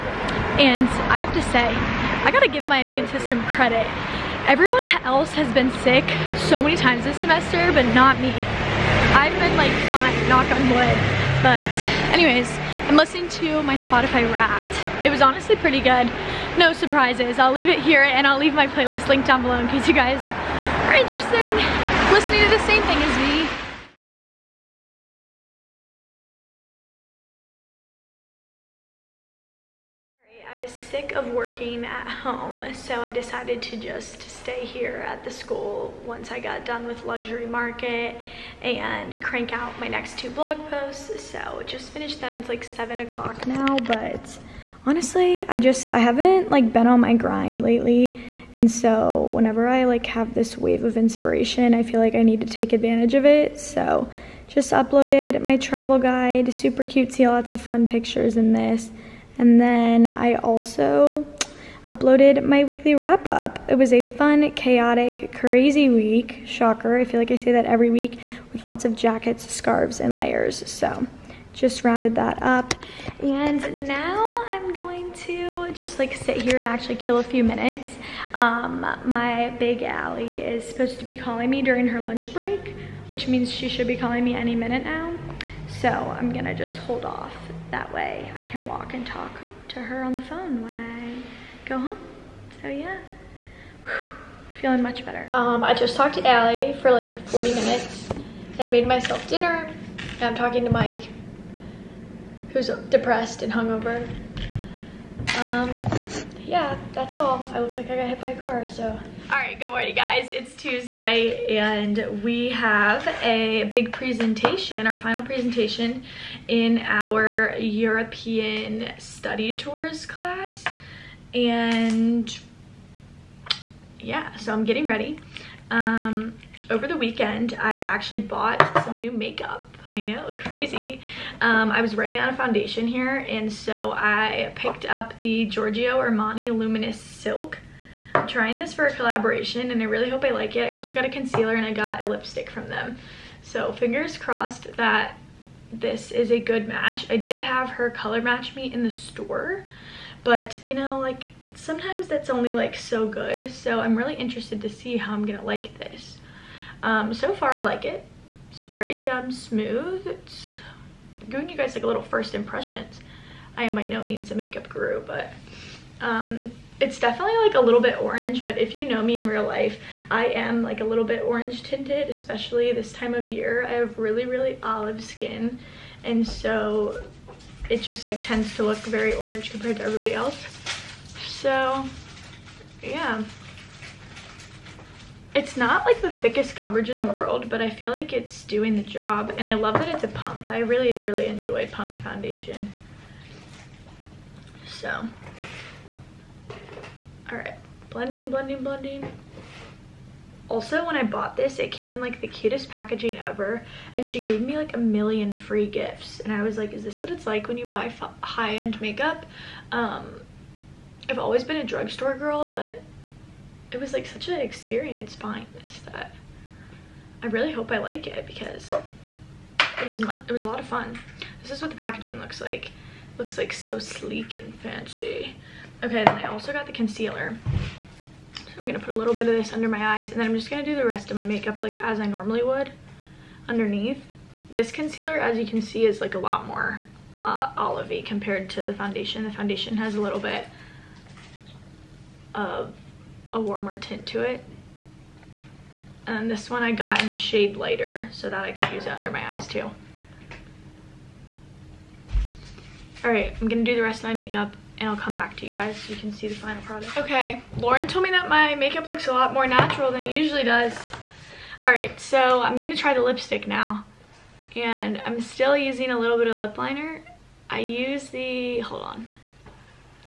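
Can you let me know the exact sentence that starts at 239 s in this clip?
The foundation has a little bit of a warmer tint to it.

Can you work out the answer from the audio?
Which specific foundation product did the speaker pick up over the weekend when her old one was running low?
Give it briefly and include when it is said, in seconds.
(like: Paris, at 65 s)
Giorgio Armani Luminous Silk, at 135 s.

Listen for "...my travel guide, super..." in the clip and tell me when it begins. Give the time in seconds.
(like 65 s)
55 s.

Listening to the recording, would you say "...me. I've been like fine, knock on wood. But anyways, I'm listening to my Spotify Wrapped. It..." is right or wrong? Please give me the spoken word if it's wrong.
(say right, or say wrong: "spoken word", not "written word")
right.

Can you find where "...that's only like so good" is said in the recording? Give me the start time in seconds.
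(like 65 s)
152 s.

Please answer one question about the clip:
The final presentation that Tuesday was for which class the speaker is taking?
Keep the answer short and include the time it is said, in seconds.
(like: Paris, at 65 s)
European study tours, at 117 s.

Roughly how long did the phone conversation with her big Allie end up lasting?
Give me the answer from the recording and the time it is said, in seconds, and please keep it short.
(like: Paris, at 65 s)
40 minutes, at 97 s.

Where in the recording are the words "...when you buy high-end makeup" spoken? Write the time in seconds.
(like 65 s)
207 s.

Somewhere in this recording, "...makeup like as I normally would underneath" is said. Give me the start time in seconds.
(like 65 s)
231 s.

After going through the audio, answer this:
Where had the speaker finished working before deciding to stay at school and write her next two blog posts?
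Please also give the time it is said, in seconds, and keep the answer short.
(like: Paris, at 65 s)
Luxury Market, at 37 s.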